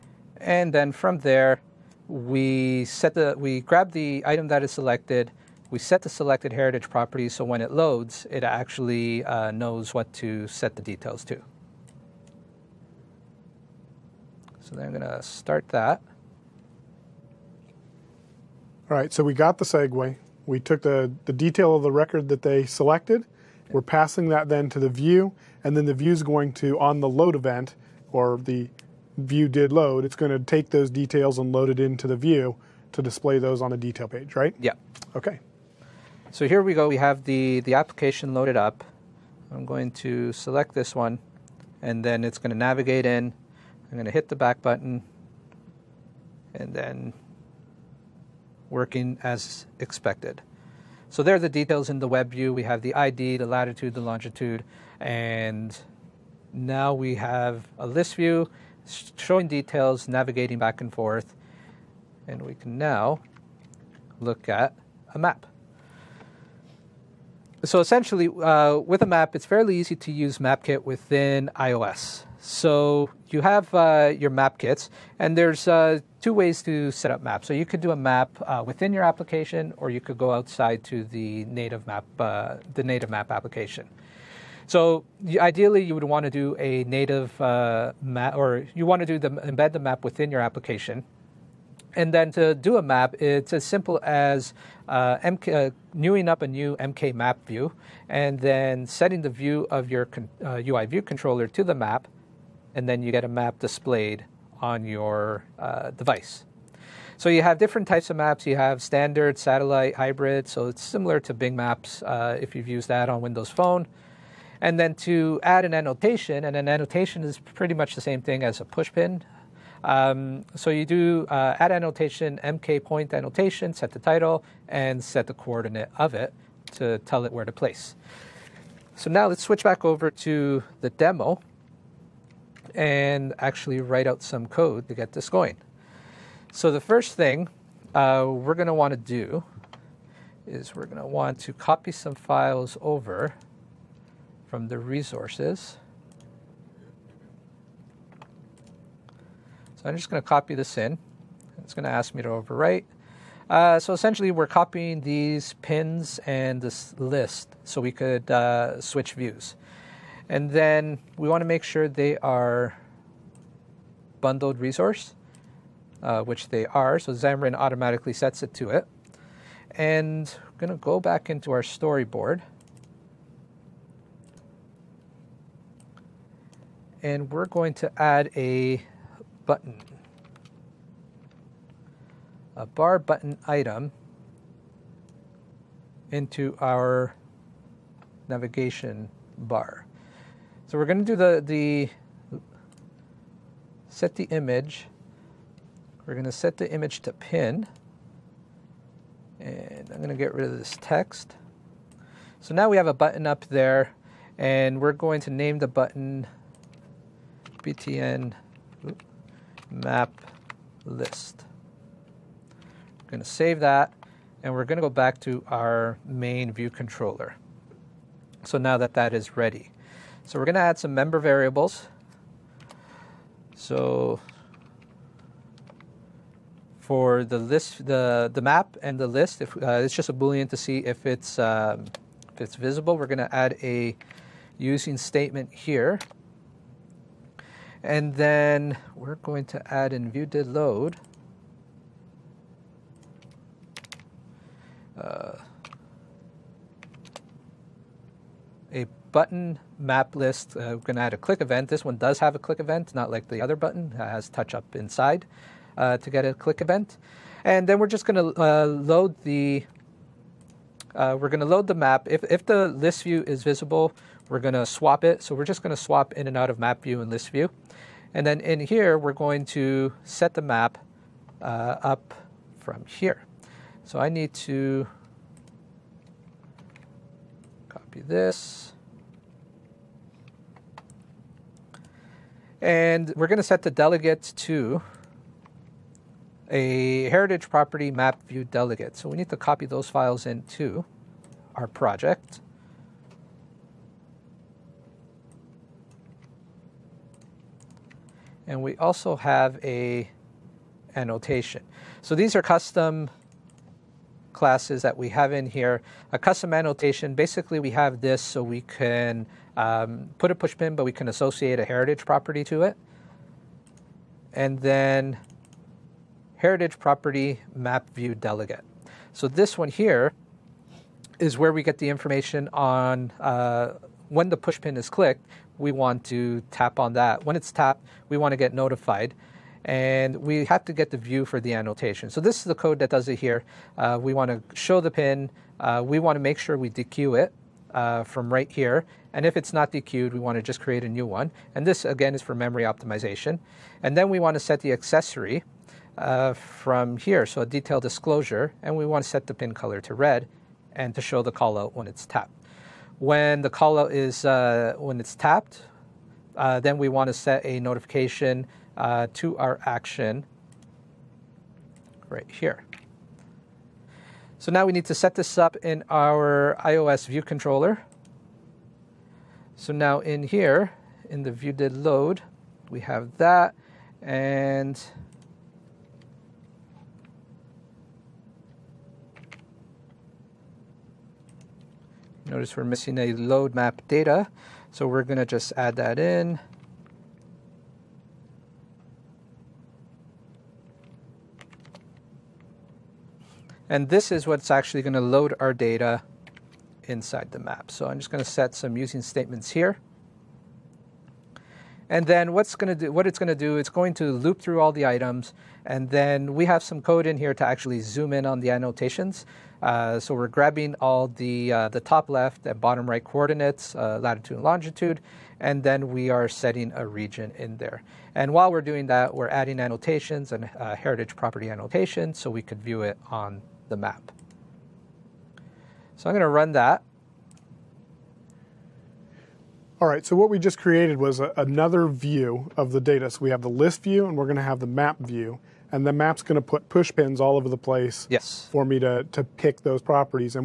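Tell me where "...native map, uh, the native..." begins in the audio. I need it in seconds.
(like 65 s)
81 s.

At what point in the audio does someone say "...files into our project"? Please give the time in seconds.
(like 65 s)
289 s.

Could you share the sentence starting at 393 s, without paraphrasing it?
And this is what's actually gonna load our data inside the map.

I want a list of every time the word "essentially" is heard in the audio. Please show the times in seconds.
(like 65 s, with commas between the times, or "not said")
67 s, 153 s.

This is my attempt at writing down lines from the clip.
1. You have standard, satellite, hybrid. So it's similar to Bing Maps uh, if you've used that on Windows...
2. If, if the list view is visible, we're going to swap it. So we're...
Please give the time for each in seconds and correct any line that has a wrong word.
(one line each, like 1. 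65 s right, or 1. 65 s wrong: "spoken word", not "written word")
1. 108 s right
2. 262 s right.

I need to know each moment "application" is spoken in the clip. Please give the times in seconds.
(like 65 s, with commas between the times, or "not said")
37 s, 79 s, 83 s, 90 s.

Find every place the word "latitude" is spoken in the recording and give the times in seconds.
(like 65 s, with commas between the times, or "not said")
53 s, 414 s.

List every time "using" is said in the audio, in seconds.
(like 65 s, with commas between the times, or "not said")
234 s, 398 s.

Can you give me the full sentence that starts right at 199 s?
And I'm going to get rid of this text.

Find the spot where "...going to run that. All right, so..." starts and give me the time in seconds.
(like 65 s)
426 s.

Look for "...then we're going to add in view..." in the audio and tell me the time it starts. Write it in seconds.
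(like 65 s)
238 s.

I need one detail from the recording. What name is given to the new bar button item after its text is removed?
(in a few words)
btn map list.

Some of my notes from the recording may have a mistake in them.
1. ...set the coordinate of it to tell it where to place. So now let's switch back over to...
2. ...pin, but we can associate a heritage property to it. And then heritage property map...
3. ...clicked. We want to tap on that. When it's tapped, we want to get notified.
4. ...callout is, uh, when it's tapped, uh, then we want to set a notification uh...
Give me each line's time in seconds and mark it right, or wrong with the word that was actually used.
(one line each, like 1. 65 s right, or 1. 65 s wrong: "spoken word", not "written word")
1. 125 s right
2. 310 s right
3. 324 s right
4. 353 s right.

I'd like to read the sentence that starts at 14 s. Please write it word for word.
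So then I'm going to start that.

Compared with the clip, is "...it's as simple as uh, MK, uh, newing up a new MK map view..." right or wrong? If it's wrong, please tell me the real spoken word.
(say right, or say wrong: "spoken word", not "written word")
right.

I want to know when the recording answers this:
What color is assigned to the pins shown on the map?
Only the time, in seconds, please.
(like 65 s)
349 s.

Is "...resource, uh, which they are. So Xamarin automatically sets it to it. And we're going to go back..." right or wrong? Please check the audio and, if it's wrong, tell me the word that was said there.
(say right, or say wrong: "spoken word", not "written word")
right.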